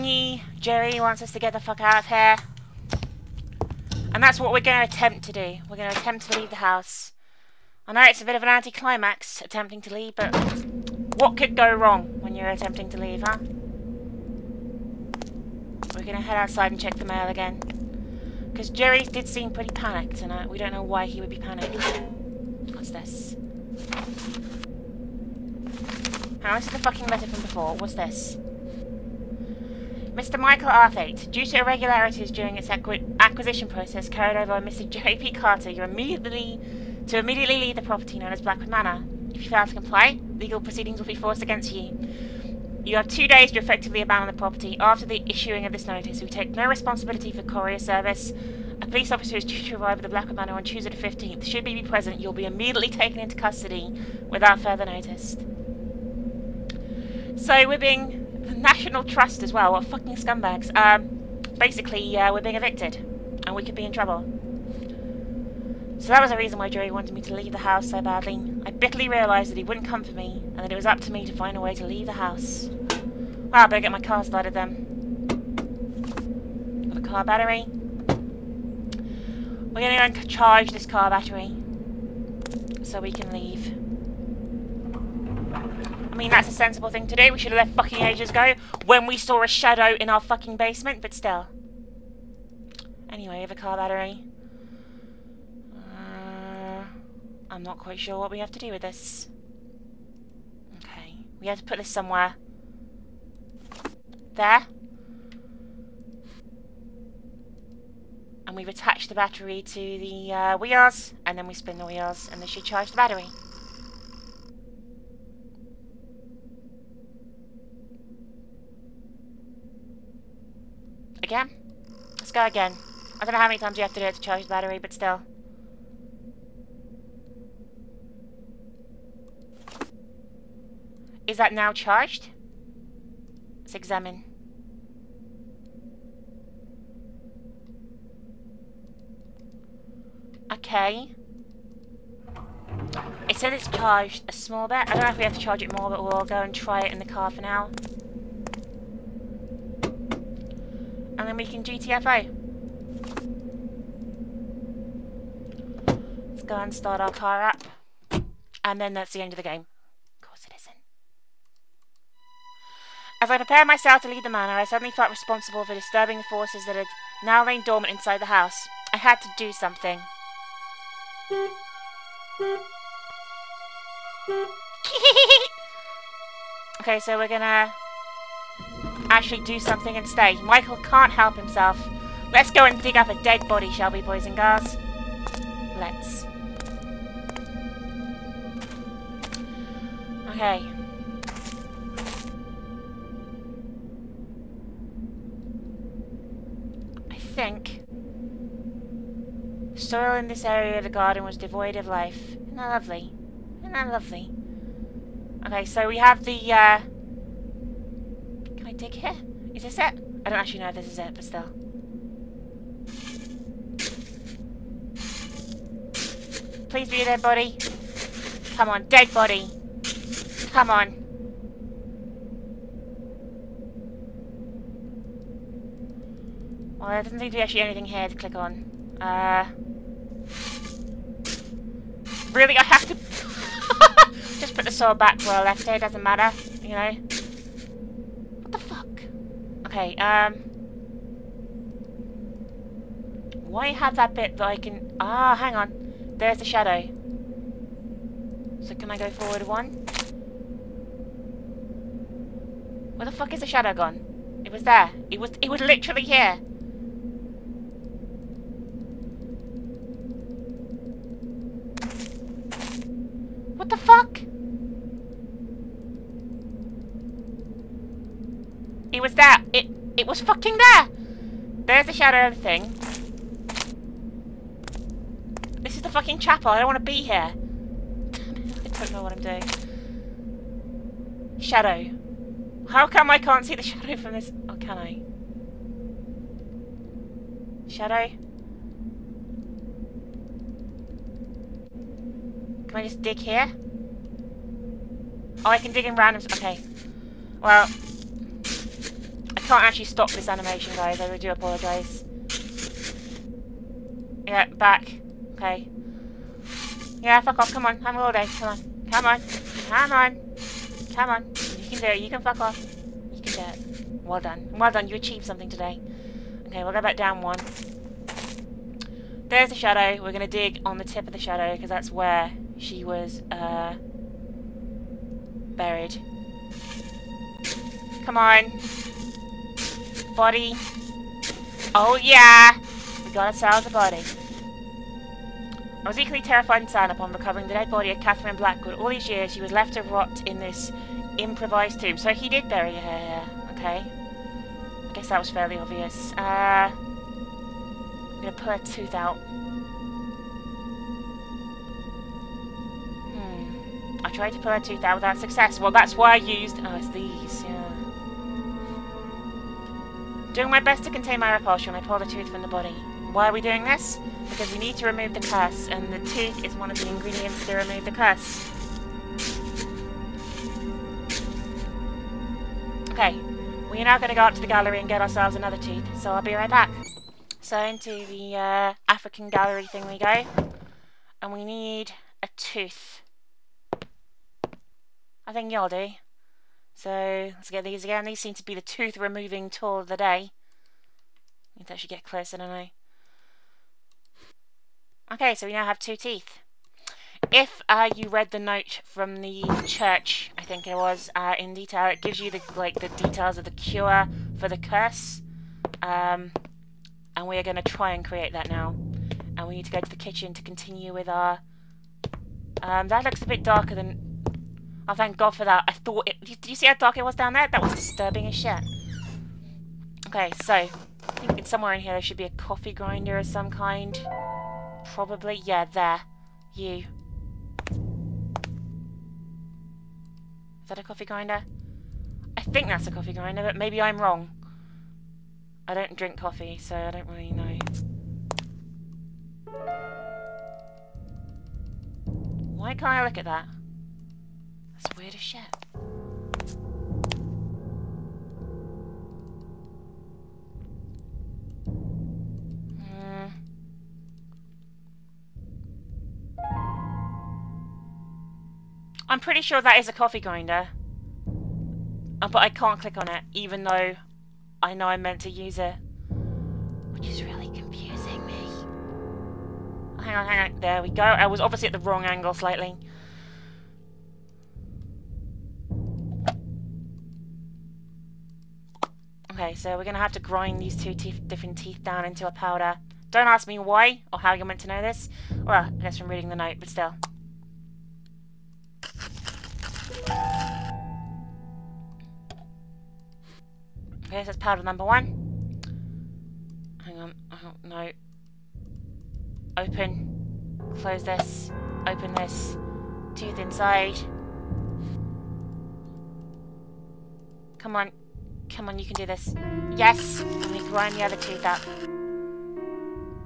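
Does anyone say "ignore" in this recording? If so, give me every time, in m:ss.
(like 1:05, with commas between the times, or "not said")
not said.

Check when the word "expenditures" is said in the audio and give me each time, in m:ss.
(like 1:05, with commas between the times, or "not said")
not said.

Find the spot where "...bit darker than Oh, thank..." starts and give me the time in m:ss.
6:53.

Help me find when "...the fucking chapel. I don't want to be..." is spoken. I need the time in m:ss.
4:35.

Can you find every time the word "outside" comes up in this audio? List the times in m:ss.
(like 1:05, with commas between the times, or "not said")
0:16.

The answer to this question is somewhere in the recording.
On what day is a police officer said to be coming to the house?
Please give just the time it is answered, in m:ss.
0:50.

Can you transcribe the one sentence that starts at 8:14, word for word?
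Okay, so that's powder number one.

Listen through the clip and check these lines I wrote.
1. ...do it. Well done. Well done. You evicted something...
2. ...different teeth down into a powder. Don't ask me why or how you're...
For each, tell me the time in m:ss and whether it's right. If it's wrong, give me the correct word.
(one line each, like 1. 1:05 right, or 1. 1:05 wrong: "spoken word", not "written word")
1. 5:13 wrong: "achieved", not "evicted"
2. 8:01 right.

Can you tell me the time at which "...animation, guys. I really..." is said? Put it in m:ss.
5:00.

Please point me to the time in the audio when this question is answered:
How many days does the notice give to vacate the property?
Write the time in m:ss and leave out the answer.
0:43.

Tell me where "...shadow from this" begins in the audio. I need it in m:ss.
4:43.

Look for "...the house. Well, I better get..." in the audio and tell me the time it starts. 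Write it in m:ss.
1:12.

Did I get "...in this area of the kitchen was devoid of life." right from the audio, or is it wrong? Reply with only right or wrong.
wrong.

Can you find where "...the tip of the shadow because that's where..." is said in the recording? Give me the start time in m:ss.
5:20.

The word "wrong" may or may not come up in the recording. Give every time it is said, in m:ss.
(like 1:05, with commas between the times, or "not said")
0:11, 7:13, 7:51.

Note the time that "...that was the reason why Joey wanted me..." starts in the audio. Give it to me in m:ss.
1:06.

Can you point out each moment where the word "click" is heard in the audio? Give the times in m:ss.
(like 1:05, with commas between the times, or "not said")
3:48, 7:42.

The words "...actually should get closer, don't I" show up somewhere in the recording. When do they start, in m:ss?
6:31.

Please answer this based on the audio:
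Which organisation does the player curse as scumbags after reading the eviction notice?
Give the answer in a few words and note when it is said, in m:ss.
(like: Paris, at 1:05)
The National Trust, at 0:58.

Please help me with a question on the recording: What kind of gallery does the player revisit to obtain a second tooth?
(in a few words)
African gallery.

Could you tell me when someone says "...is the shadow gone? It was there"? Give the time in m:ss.
4:13.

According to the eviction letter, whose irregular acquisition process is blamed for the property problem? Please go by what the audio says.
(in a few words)
J. P. Carter.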